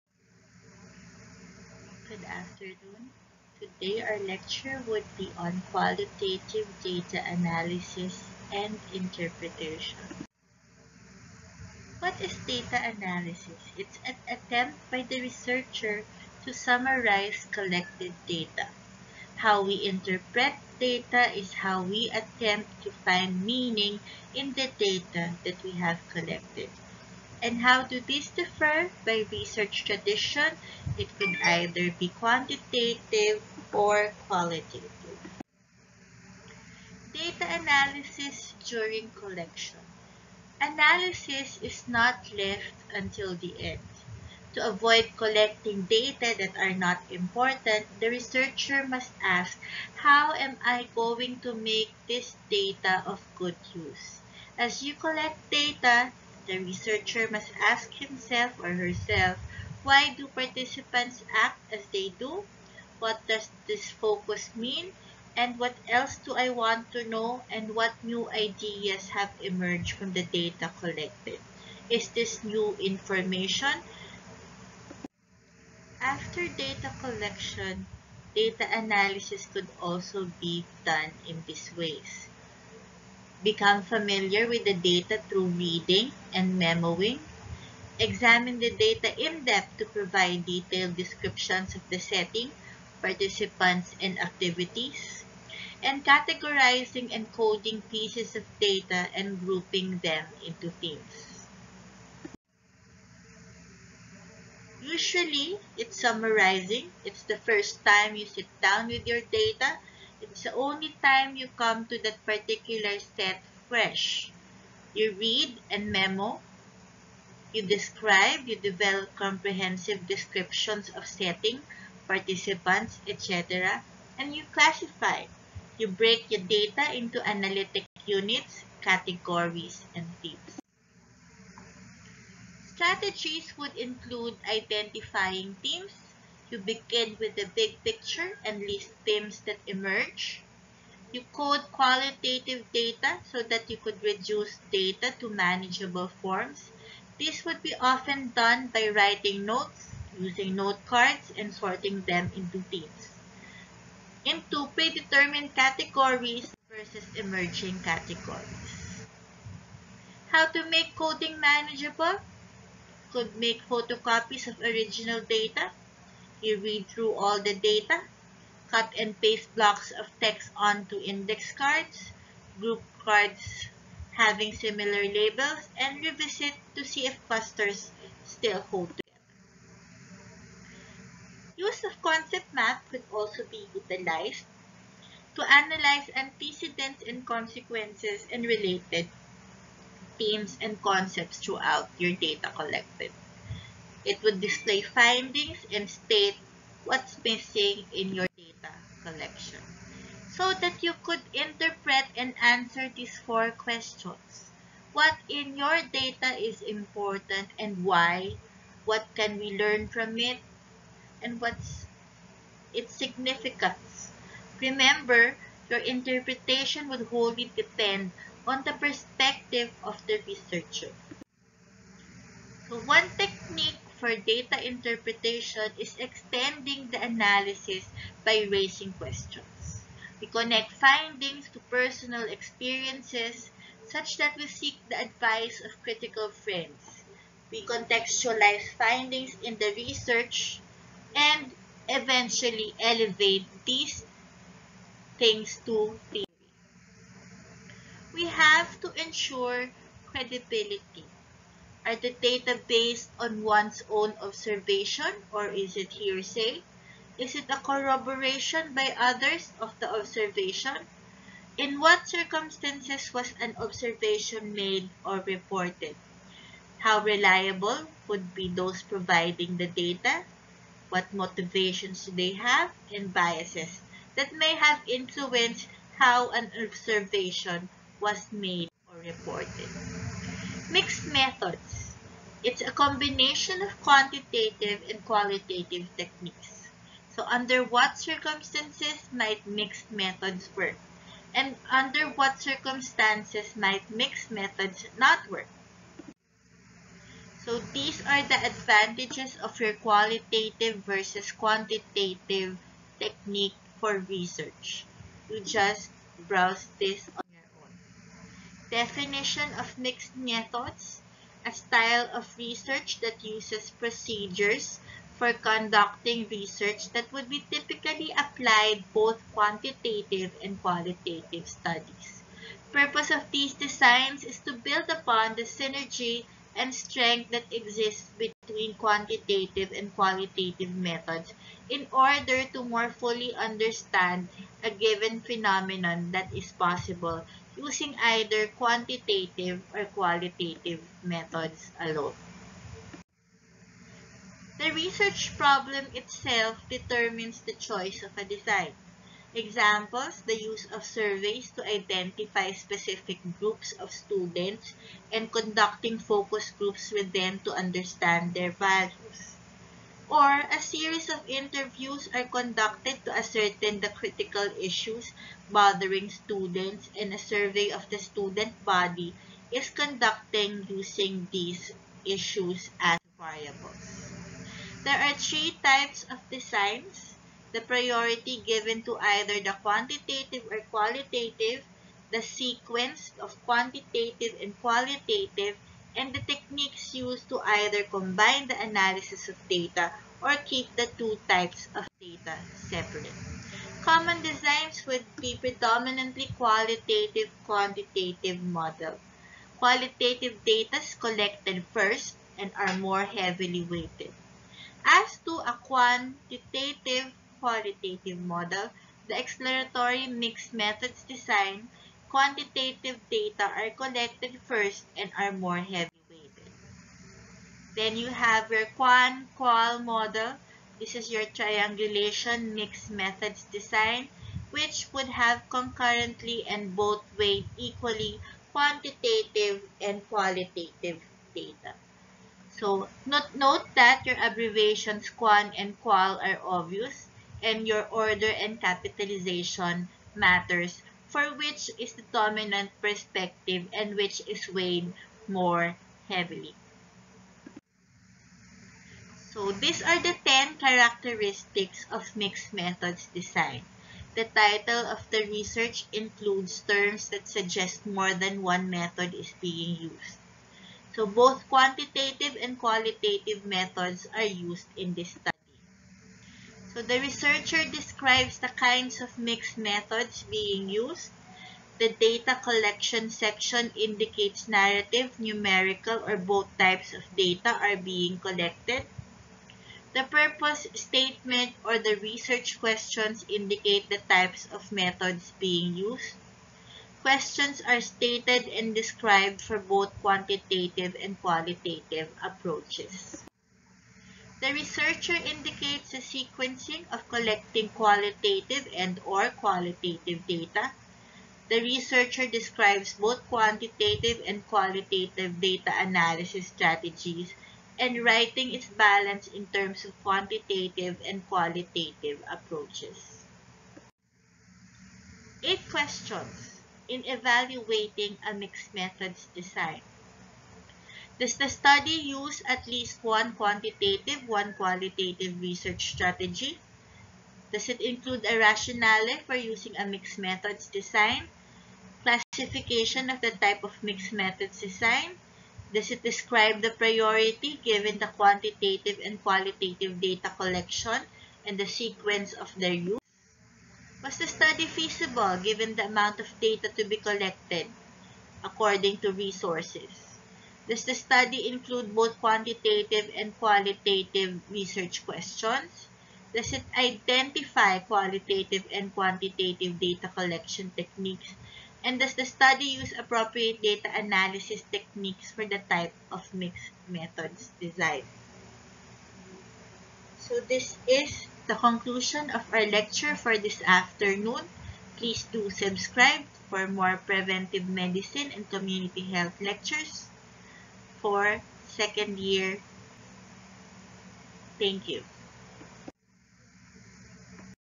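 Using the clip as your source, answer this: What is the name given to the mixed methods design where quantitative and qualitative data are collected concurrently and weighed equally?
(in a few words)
triangulation mixed methods design.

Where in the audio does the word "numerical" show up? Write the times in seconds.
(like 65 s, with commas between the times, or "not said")
475 s.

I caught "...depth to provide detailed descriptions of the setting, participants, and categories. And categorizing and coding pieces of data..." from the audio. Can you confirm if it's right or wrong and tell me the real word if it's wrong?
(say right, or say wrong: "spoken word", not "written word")
wrong: "activities", not "categories".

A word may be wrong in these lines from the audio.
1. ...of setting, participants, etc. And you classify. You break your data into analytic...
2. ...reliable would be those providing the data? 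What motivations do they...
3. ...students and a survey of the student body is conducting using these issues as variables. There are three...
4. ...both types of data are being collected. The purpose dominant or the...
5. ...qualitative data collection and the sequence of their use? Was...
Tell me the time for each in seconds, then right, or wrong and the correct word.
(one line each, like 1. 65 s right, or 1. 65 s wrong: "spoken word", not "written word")
1. 120 s right
2. 267 s right
3. 366 s right
4. 476 s wrong: "statement", not "dominant"
5. 539 s right.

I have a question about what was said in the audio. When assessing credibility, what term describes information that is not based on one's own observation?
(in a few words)
hearsay.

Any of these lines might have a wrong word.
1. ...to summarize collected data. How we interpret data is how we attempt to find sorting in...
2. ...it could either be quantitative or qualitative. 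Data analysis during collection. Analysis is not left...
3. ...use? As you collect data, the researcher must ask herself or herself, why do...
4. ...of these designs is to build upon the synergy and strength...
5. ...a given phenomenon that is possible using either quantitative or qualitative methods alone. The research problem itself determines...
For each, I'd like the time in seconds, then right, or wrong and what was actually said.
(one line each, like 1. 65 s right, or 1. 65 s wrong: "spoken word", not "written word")
1. 16 s wrong: "meaning", not "sorting"
2. 30 s right
3. 53 s wrong: "himself", not "herself"
4. 323 s right
5. 334 s right.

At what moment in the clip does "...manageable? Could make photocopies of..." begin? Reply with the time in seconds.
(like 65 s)
161 s.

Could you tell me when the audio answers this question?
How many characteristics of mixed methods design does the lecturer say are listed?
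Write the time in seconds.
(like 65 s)
450 s.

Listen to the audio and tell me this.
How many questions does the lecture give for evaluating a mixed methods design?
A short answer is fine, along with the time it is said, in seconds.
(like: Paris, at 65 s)
8, at 515 s.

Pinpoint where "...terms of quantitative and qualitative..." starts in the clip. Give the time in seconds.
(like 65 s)
509 s.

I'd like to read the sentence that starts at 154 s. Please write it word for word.
Into predetermined categories versus emerging categories.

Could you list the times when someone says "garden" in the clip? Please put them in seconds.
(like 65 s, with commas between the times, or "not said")
not said.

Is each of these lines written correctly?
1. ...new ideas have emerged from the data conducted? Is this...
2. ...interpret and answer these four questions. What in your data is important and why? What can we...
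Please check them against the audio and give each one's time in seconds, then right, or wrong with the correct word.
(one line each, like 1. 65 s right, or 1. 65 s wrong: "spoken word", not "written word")
1. 68 s wrong: "collected", not "conducted"
2. 201 s right.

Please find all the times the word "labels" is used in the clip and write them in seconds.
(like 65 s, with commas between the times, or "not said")
175 s.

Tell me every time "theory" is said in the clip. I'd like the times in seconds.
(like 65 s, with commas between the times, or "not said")
246 s.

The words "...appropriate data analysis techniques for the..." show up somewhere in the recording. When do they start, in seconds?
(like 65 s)
562 s.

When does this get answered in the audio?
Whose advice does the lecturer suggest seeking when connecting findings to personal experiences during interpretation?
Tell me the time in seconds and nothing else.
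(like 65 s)
235 s.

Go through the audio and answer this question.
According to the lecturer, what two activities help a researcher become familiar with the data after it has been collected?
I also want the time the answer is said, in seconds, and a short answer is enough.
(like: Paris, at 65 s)
reading and memoing, at 85 s.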